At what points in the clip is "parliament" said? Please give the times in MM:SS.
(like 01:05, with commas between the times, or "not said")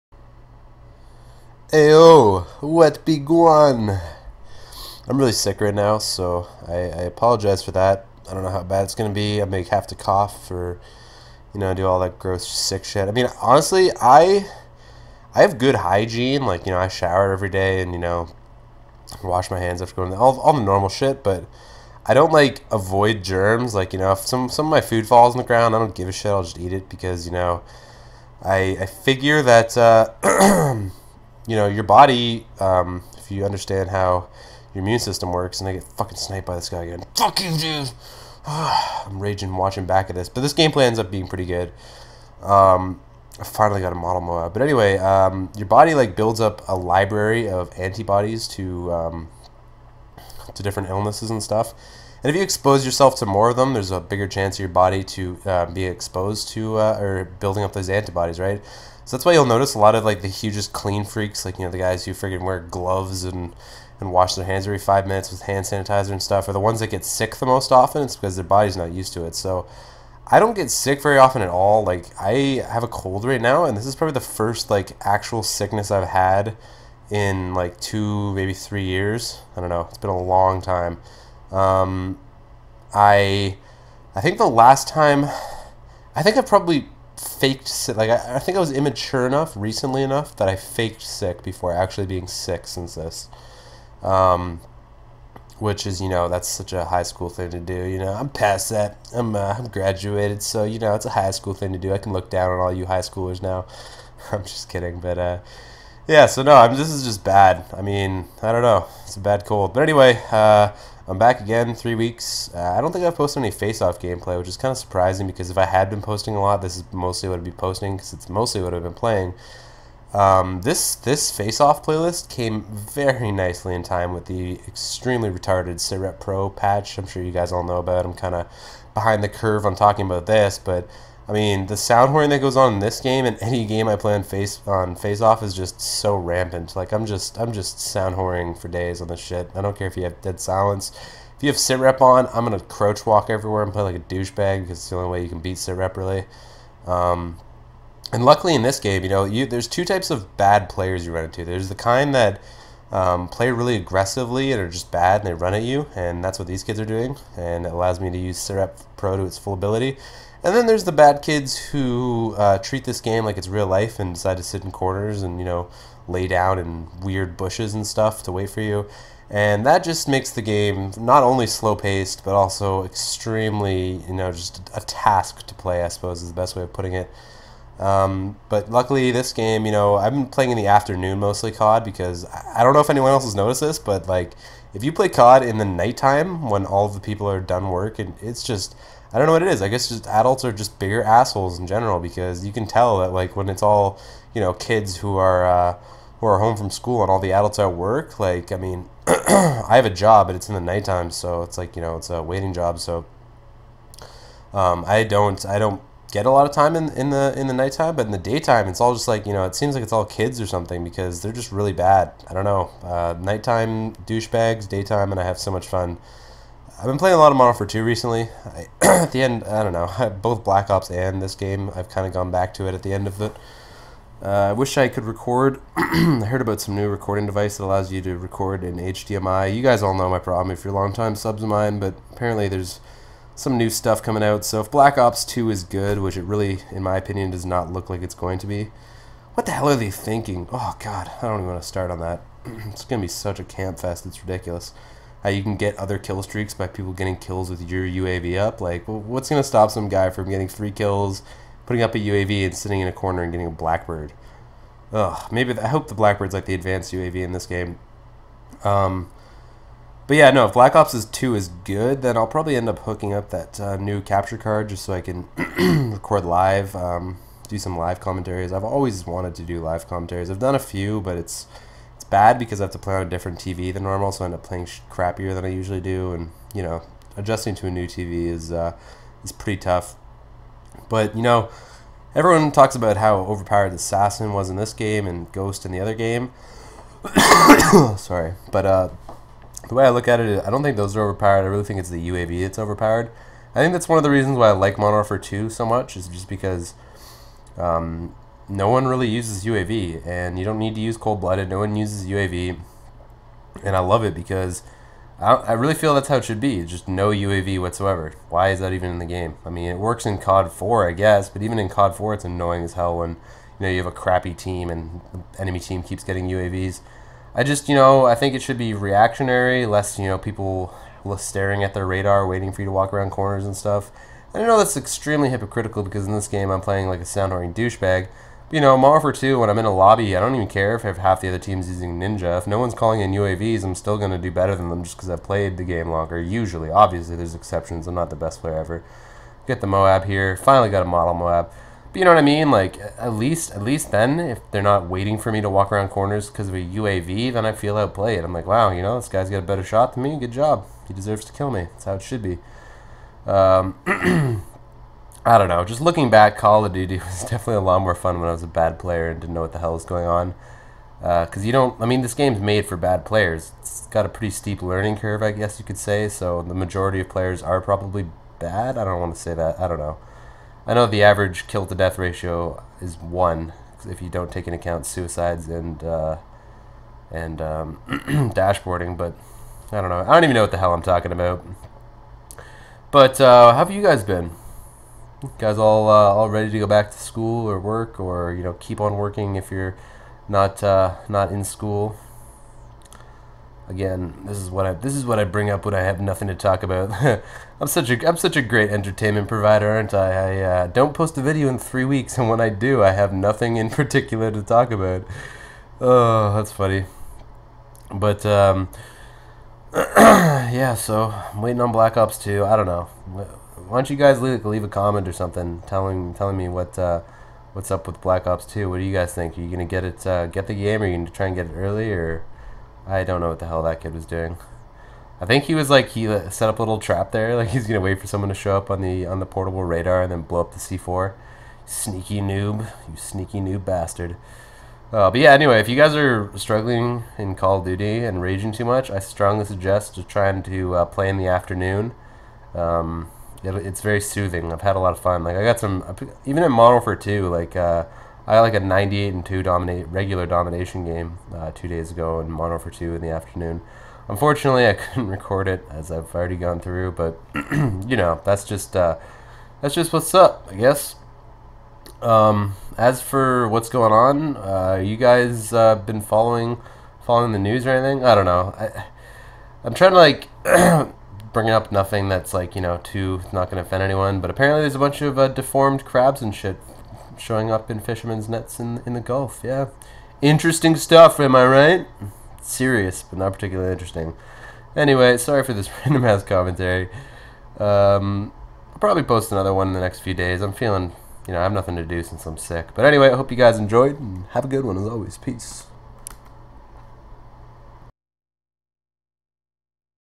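not said.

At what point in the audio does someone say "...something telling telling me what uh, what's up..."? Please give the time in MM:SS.
06:55.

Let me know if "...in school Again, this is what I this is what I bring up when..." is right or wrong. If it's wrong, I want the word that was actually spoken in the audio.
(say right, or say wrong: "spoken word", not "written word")
right.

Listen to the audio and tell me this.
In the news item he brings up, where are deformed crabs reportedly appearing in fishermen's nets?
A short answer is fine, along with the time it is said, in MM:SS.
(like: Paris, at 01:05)
the Gulf, at 07:58.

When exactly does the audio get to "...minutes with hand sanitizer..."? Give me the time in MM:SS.
01:05.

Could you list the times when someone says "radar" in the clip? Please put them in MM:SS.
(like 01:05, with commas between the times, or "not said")
05:21, 07:09.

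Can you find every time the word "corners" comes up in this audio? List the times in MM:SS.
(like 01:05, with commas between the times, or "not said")
02:44, 04:12, 05:23, 05:45.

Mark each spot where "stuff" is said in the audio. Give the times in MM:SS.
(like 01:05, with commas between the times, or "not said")
00:51, 01:06, 02:47, 03:53, 05:23, 08:00.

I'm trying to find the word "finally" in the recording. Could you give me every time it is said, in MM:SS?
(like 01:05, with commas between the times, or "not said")
00:43, 05:40.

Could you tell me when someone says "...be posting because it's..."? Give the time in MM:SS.
01:57.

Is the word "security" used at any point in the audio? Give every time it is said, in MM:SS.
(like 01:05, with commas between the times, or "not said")
not said.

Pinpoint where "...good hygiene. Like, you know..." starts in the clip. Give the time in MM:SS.
00:15.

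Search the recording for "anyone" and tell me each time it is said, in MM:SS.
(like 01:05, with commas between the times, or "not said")
03:02, 07:53.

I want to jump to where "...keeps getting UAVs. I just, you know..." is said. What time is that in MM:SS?
05:15.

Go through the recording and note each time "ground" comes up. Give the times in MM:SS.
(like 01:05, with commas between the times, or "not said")
00:25.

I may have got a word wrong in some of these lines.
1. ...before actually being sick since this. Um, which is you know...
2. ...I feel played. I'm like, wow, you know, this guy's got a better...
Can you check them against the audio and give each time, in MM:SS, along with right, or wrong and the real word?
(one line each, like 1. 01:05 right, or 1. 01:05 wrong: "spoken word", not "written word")
1. 01:31 right
2. 05:47 wrong: "outplayed", not "played".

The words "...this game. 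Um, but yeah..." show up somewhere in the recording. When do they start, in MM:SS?
04:17.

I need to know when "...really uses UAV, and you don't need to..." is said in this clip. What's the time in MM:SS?
04:58.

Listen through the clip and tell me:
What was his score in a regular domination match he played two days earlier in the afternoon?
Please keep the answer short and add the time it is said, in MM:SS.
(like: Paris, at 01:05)
98 and 2, at 07:28.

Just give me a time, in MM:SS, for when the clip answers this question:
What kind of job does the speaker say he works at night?
03:22.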